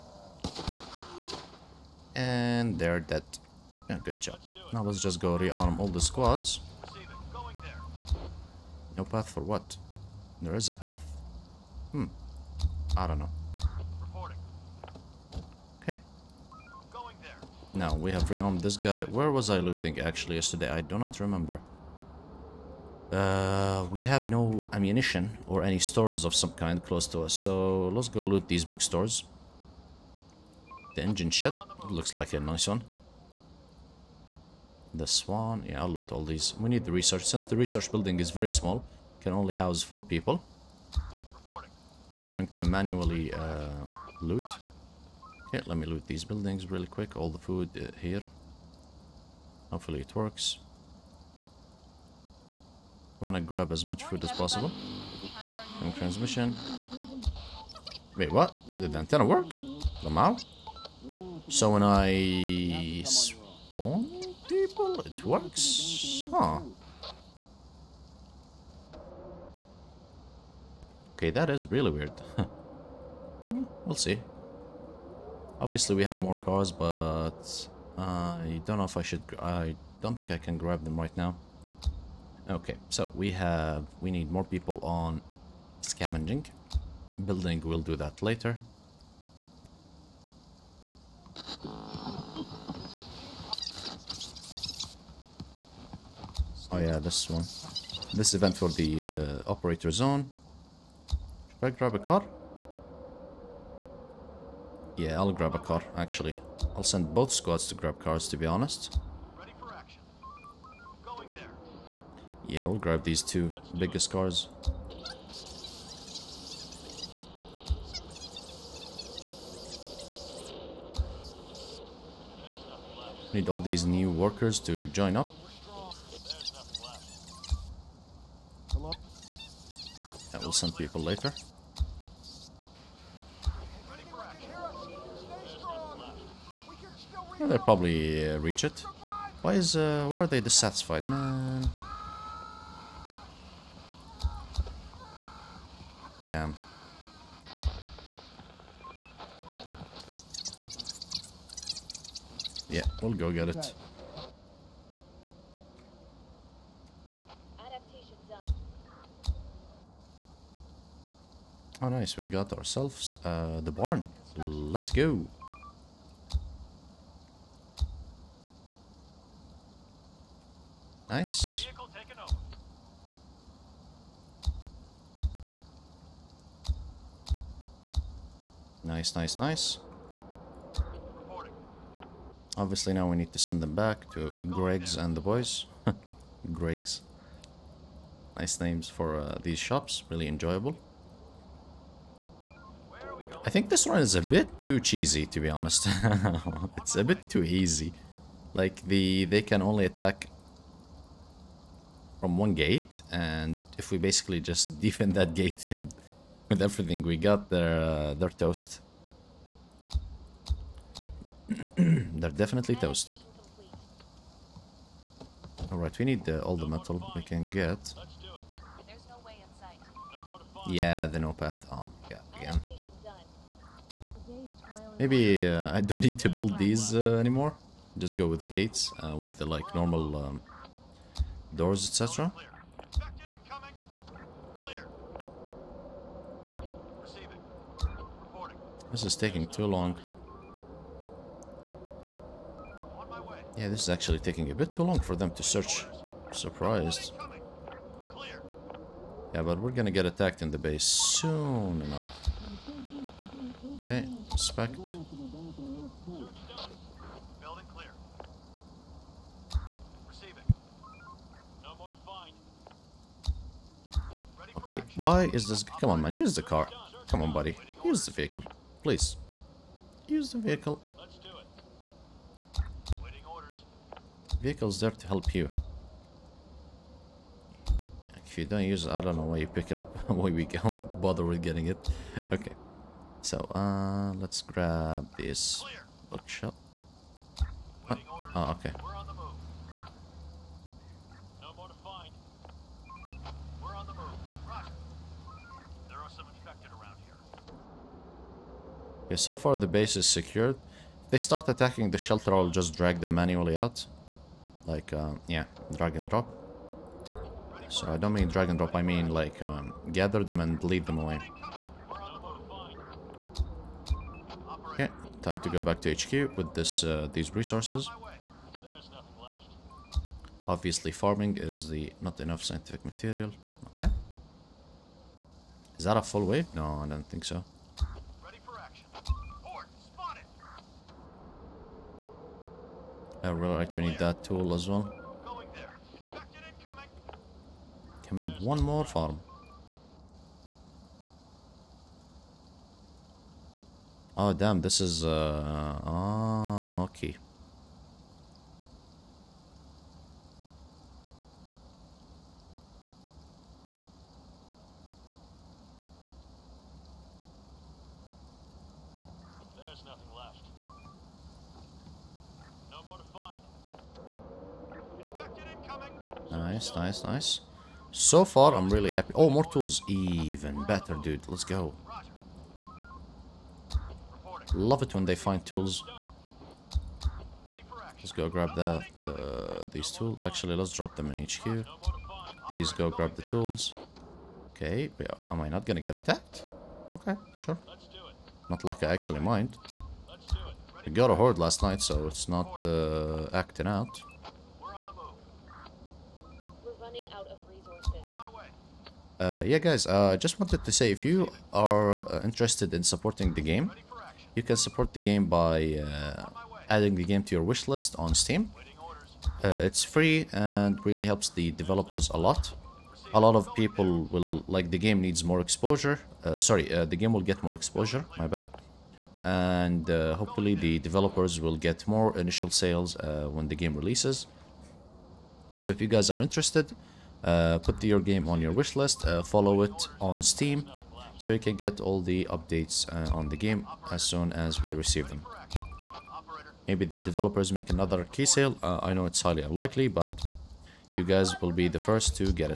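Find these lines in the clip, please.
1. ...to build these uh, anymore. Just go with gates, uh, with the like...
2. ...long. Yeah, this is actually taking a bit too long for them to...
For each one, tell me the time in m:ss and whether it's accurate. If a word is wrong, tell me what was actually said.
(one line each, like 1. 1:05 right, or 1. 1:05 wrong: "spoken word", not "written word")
1. 3:46 right
2. 3:59 right.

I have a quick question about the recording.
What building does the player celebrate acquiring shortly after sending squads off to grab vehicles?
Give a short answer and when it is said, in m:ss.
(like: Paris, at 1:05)
The barn, at 2:43.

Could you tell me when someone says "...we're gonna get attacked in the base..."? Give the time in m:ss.
4:09.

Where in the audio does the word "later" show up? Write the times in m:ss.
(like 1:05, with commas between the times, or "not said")
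1:28, 2:11.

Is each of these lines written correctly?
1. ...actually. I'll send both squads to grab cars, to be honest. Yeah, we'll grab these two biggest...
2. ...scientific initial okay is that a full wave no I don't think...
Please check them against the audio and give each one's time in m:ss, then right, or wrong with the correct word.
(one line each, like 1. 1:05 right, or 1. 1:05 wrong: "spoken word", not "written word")
1. 1:45 right
2. 5:22 wrong: "material", not "initial".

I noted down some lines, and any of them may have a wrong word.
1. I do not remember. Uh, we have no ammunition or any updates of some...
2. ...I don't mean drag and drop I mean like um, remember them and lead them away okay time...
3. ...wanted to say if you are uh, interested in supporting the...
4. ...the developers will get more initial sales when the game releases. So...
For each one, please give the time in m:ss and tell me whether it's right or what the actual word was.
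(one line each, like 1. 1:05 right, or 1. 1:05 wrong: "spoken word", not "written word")
1. 0:20 wrong: "stores", not "updates"
2. 5:07 wrong: "gather", not "remember"
3. 6:40 right
4. 7:00 right.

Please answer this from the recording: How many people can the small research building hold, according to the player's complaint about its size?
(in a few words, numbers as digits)
4.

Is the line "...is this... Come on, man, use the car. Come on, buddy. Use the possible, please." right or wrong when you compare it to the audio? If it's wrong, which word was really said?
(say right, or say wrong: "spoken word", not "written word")
wrong: "vehicle", not "possible".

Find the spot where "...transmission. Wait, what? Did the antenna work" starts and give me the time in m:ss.
0:55.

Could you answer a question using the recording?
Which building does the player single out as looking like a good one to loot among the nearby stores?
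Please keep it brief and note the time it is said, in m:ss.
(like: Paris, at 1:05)
The engine shed, at 0:31.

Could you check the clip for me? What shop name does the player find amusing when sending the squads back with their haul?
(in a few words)
Greg's and the boys.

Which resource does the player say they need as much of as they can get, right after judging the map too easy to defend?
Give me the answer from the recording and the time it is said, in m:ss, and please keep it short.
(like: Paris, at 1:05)
Metal, at 3:36.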